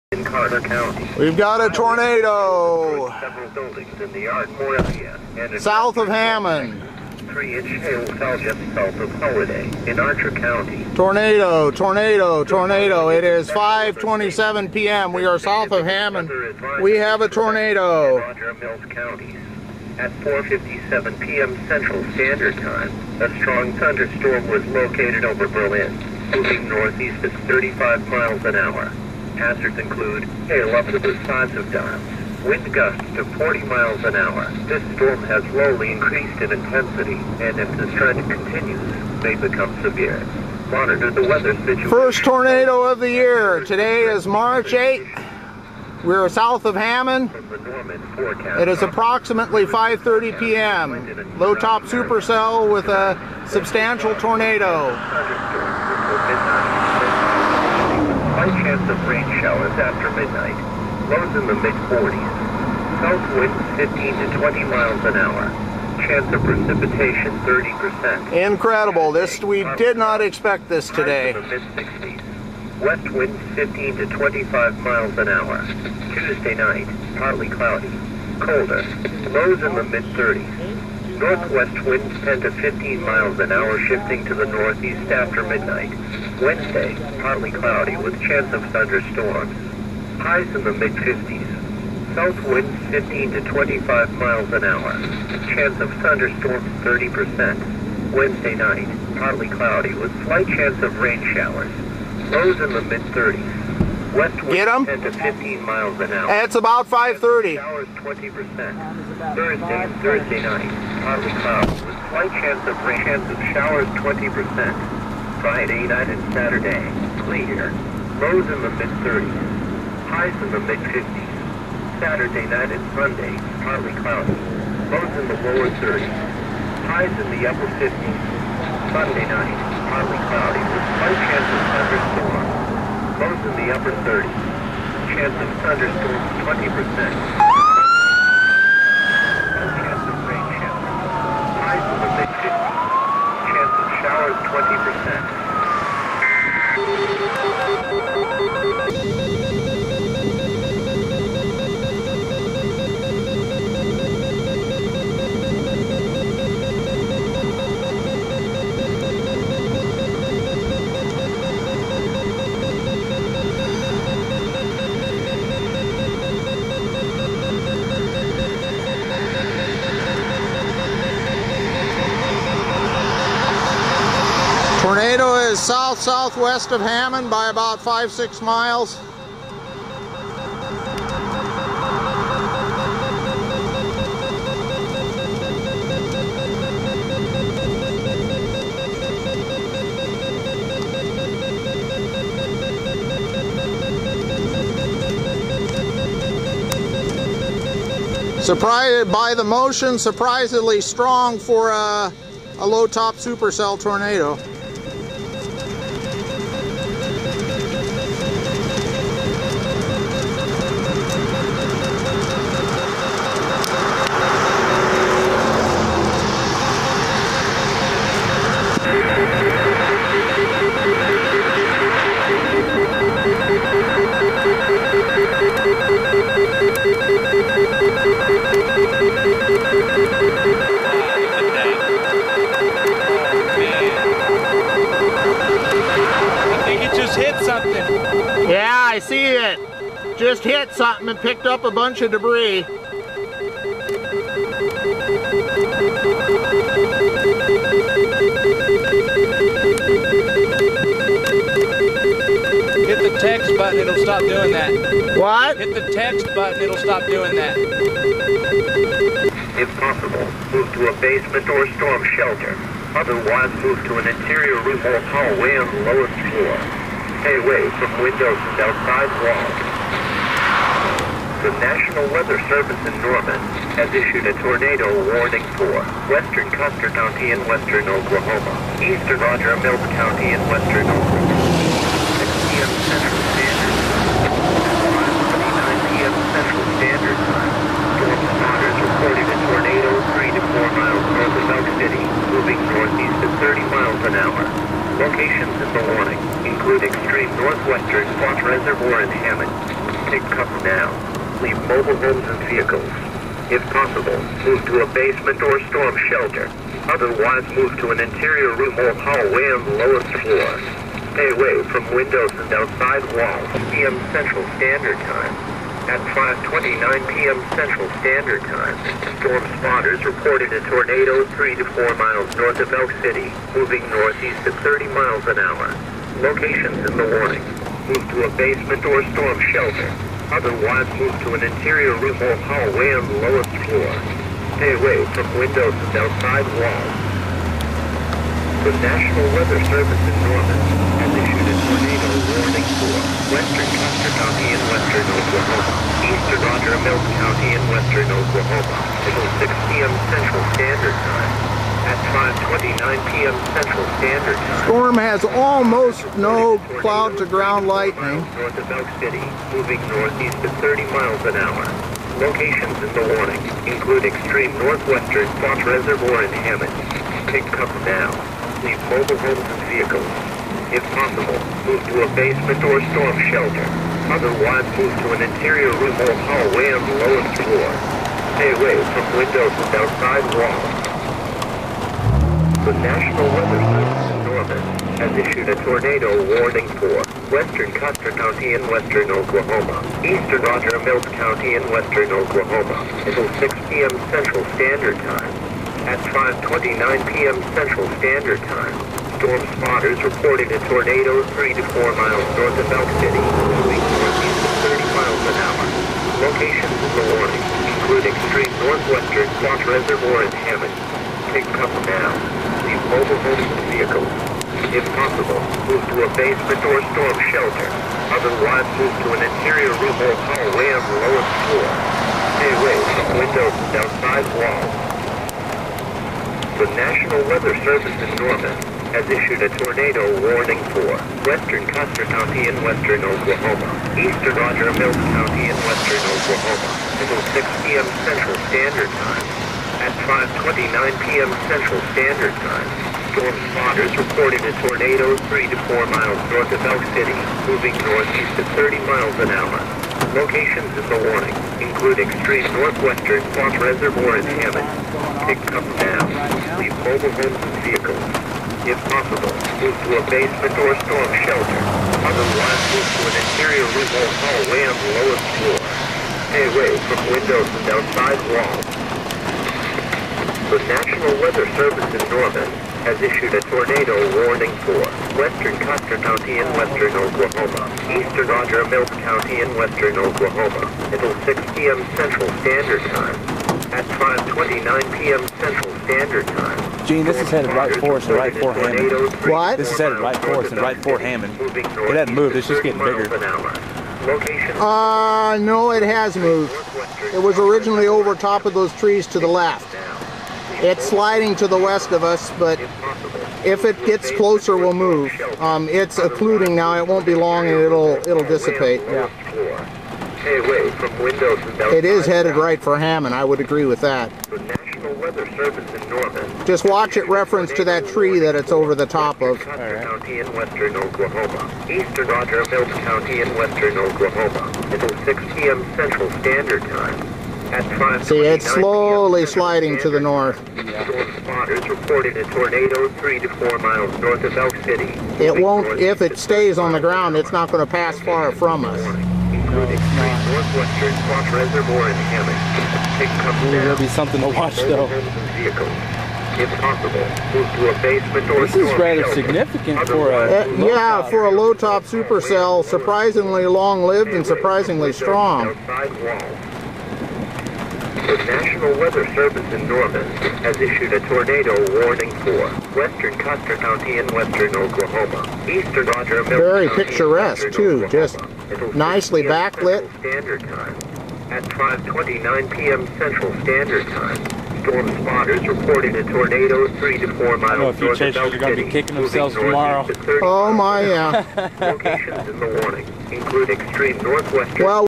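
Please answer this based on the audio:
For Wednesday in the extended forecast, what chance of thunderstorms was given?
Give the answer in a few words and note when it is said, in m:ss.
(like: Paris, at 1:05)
30%, at 1:35.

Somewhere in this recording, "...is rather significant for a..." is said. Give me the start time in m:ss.
9:08.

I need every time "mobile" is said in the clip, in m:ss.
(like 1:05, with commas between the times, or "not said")
5:01, 6:08, 6:52, 7:36.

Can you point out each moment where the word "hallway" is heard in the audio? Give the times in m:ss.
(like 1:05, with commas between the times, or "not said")
4:25, 5:08, 5:32, 6:16, 7:00, 7:44.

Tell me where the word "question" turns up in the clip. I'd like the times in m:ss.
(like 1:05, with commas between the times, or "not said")
not said.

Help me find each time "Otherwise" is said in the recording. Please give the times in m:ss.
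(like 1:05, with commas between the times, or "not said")
4:22, 5:06, 5:30, 6:14, 6:58, 7:42.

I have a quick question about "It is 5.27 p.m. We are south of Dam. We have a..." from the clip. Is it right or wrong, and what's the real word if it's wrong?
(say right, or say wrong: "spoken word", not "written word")
wrong: "Hammon", not "Dam".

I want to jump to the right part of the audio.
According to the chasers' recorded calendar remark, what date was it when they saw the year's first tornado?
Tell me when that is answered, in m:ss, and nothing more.
0:44.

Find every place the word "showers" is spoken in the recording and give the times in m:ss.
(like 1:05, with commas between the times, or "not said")
0:59, 1:41, 1:53.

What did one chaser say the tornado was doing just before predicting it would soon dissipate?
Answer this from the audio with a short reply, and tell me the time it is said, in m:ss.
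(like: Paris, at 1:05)
occluding, at 8:25.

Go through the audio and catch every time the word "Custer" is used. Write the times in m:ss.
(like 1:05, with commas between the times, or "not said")
4:36, 5:43, 6:27, 7:11, 7:55, 9:23.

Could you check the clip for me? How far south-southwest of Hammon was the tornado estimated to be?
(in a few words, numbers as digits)
five, six miles.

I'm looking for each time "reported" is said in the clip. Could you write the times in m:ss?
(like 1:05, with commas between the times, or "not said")
4:48, 5:20, 6:40, 7:23, 8:51, 9:35.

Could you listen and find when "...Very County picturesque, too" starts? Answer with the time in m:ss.
9:26.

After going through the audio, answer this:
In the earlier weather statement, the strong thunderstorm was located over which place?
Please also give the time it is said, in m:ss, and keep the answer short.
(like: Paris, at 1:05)
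Berlin, at 0:25.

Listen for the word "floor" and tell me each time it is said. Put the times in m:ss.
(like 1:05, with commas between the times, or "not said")
4:26, 5:10, 5:33, 6:17, 7:01, 7:45.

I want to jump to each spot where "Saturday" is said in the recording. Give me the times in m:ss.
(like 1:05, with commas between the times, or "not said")
1:56, 2:02.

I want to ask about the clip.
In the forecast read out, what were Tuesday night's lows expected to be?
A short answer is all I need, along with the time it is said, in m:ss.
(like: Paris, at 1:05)
mid-30s, at 1:19.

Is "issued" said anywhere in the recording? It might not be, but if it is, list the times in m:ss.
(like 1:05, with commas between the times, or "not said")
4:33, 6:25, 7:09, 7:53, 9:20.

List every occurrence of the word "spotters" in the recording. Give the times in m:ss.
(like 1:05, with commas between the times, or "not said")
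4:48, 5:19, 6:39, 7:23, 8:51, 9:35.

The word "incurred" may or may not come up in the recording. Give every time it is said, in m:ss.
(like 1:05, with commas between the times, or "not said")
not said.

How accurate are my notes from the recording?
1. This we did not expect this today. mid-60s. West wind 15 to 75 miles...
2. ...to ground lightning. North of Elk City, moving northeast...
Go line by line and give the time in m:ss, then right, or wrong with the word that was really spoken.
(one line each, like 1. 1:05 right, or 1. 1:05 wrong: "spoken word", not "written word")
1. 1:09 wrong: "25", not "75"
2. 5:57 right.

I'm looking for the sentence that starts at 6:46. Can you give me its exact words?
Locations of the warning include extreme northwestern, Foss Reservoir, and Hammon.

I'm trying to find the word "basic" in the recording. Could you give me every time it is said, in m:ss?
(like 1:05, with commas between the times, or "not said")
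not said.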